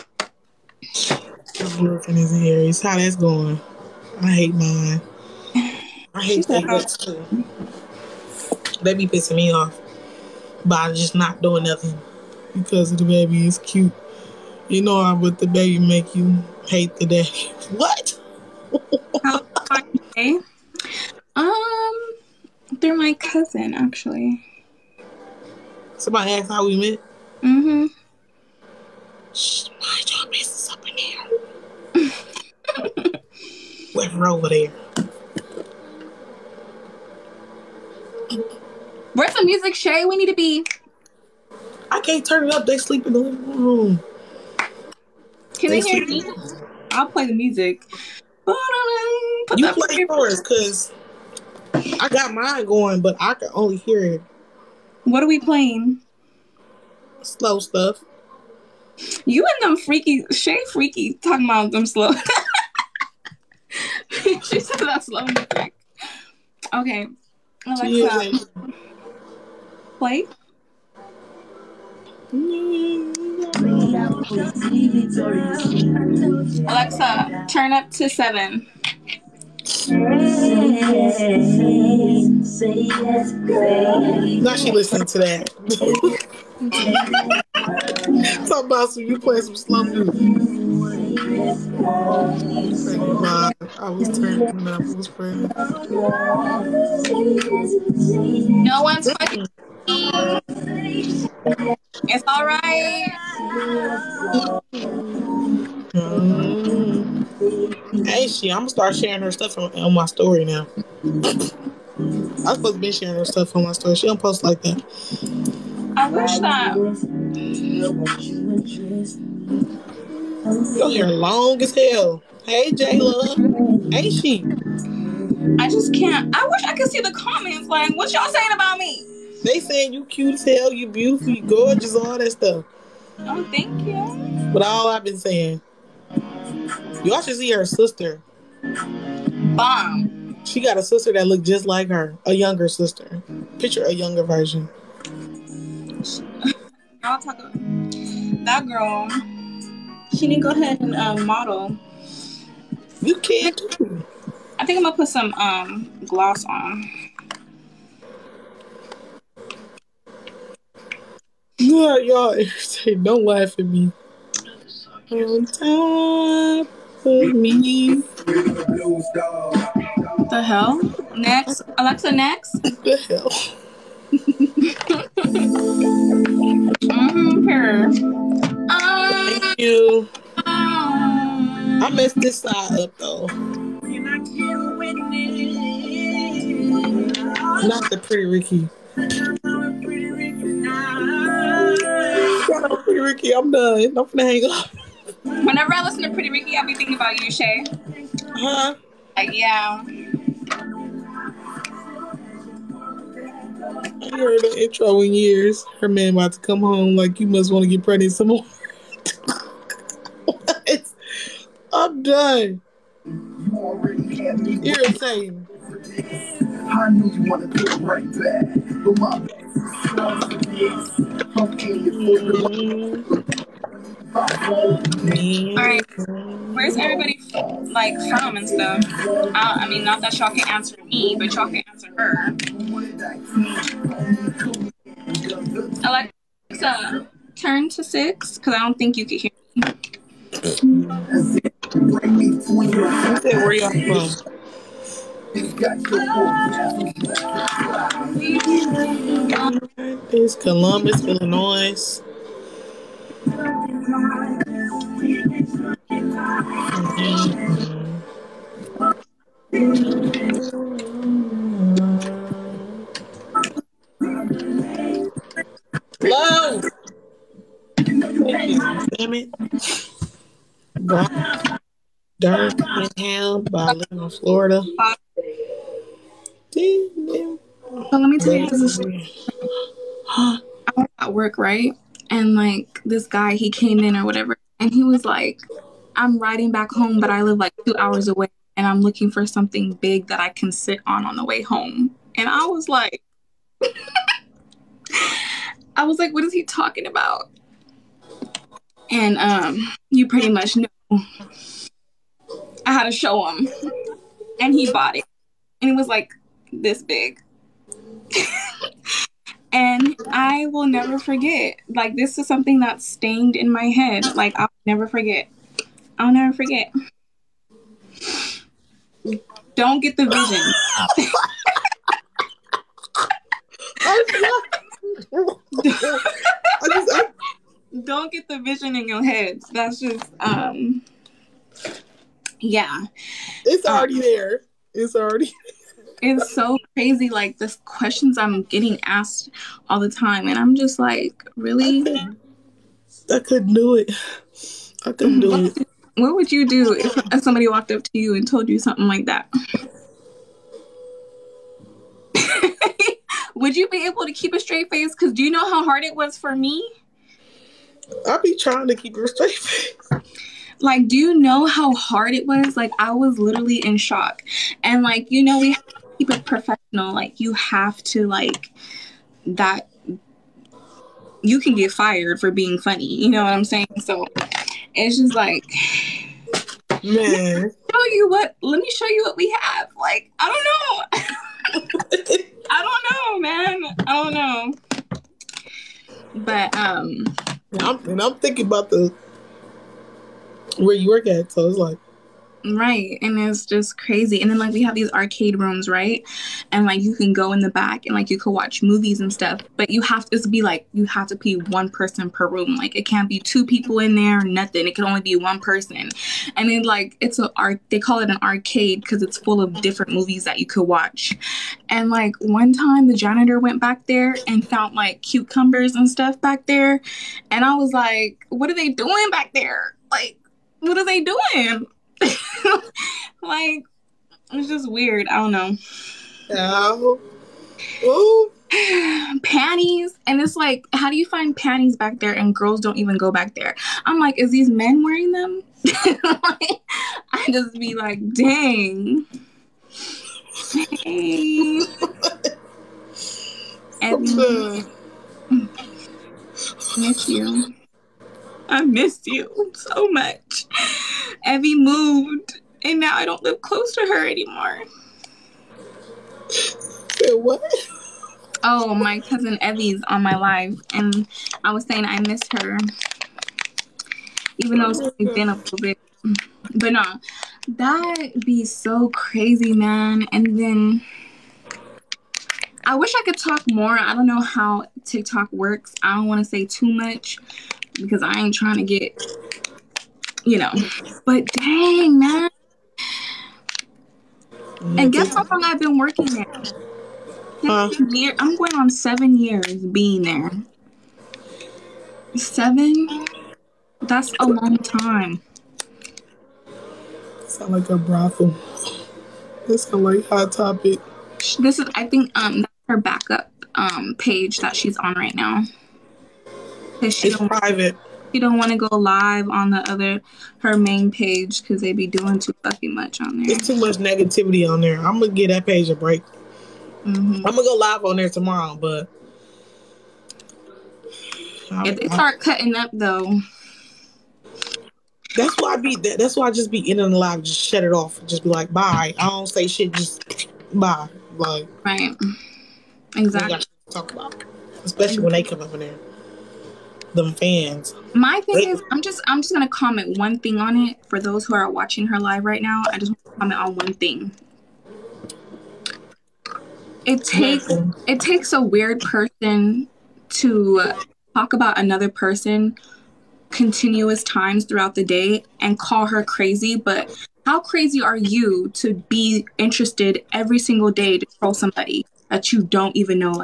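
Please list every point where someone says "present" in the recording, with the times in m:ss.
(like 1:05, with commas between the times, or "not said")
not said.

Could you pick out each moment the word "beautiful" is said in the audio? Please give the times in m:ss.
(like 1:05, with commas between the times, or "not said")
2:10.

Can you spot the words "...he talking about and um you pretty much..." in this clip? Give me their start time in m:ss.
4:56.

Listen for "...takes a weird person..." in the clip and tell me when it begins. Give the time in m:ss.
9:08.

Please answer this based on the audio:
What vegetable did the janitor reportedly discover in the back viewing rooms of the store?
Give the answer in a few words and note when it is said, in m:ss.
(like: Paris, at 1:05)
cucumbers, at 6:55.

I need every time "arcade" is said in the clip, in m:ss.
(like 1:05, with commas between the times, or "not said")
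6:34, 6:48.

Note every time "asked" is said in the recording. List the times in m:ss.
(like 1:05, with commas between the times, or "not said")
0:26, 5:38.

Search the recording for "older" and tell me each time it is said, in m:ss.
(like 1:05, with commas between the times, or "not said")
not said.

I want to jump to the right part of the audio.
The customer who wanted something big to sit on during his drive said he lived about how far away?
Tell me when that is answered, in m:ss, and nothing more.
4:47.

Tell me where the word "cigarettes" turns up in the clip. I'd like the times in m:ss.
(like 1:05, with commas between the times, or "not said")
0:06.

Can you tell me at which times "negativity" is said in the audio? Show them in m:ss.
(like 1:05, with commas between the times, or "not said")
8:33.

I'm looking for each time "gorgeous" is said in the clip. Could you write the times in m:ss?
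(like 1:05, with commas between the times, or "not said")
2:11.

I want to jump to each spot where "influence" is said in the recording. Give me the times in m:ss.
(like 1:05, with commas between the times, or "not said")
not said.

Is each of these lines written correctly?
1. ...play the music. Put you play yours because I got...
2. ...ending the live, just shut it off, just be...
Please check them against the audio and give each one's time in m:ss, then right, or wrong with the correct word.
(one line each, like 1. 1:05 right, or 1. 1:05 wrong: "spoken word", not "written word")
1. 0:47 right
2. 8:46 right.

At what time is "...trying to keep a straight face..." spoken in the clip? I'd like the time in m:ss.
5:58.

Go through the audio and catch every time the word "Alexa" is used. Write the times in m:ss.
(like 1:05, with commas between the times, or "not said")
1:07, 1:16, 2:51, 3:56.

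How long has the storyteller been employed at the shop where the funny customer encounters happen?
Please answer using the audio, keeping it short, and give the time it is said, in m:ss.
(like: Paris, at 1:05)
7 years, at 8:08.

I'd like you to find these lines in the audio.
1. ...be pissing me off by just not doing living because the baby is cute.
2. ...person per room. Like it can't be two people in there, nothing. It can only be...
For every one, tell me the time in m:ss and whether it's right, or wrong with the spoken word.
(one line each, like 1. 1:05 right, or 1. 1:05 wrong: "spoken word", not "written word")
1. 0:09 wrong: "nothing", not "living"
2. 6:41 right.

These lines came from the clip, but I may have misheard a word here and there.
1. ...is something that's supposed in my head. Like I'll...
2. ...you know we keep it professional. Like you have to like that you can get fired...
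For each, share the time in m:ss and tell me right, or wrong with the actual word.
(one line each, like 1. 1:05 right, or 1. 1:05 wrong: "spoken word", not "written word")
1. 5:12 wrong: "stained", not "supposed"
2. 6:05 right.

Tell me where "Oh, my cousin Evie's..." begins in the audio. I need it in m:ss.
7:38.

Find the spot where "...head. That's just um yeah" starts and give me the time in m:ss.
5:29.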